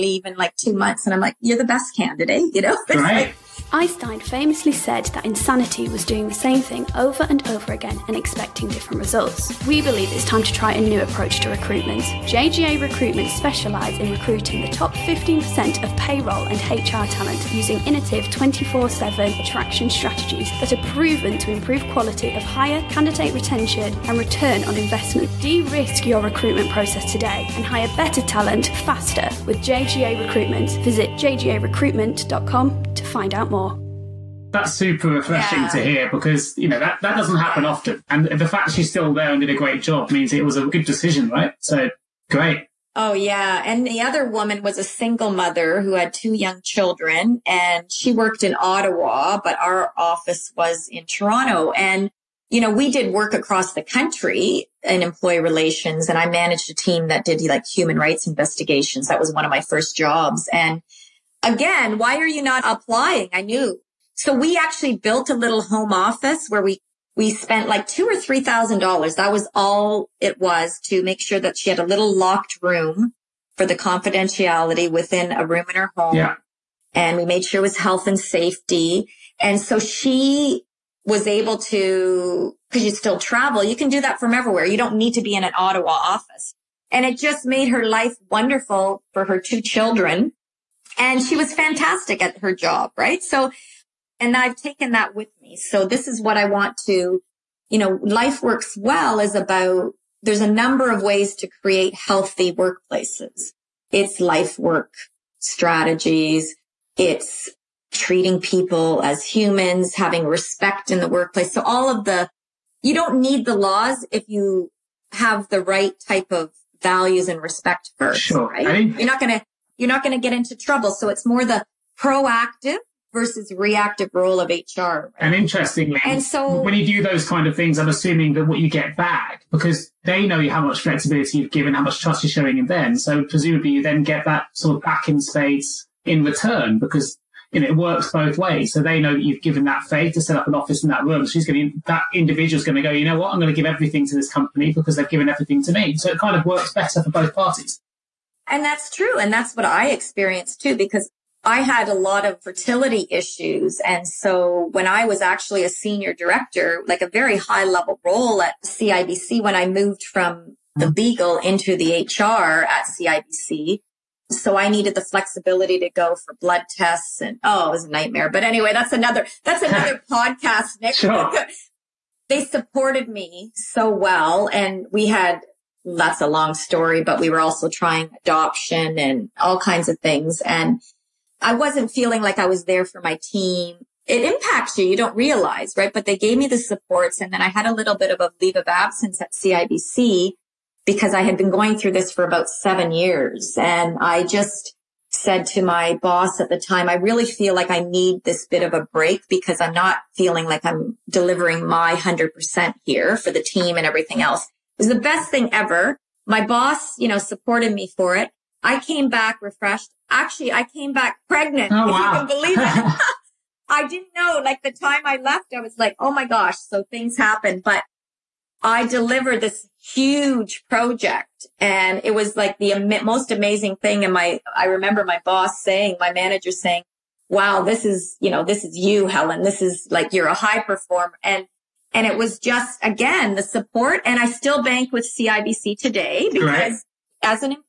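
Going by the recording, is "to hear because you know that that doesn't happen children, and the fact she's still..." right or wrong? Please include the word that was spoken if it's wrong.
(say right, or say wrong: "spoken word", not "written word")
wrong: "often", not "children".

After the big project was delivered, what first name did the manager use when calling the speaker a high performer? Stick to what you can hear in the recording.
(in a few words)
Helen.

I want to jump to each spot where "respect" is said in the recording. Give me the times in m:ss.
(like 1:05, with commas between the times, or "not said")
1:50, 1:57.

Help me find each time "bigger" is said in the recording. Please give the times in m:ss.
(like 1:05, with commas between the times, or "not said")
not said.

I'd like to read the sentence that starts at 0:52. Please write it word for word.
You know, we did work across the country in employee relations and I managed a team that did like human rights investigations.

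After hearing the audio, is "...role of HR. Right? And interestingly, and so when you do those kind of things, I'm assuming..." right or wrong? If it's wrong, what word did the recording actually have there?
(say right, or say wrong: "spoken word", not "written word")
right.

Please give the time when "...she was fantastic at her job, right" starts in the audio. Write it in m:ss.
1:31.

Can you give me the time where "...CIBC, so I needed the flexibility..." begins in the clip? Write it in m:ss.
2:43.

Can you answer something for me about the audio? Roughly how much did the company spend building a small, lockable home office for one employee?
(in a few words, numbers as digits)
$2,000-$3,000.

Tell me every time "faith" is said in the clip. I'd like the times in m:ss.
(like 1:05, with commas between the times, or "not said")
2:19.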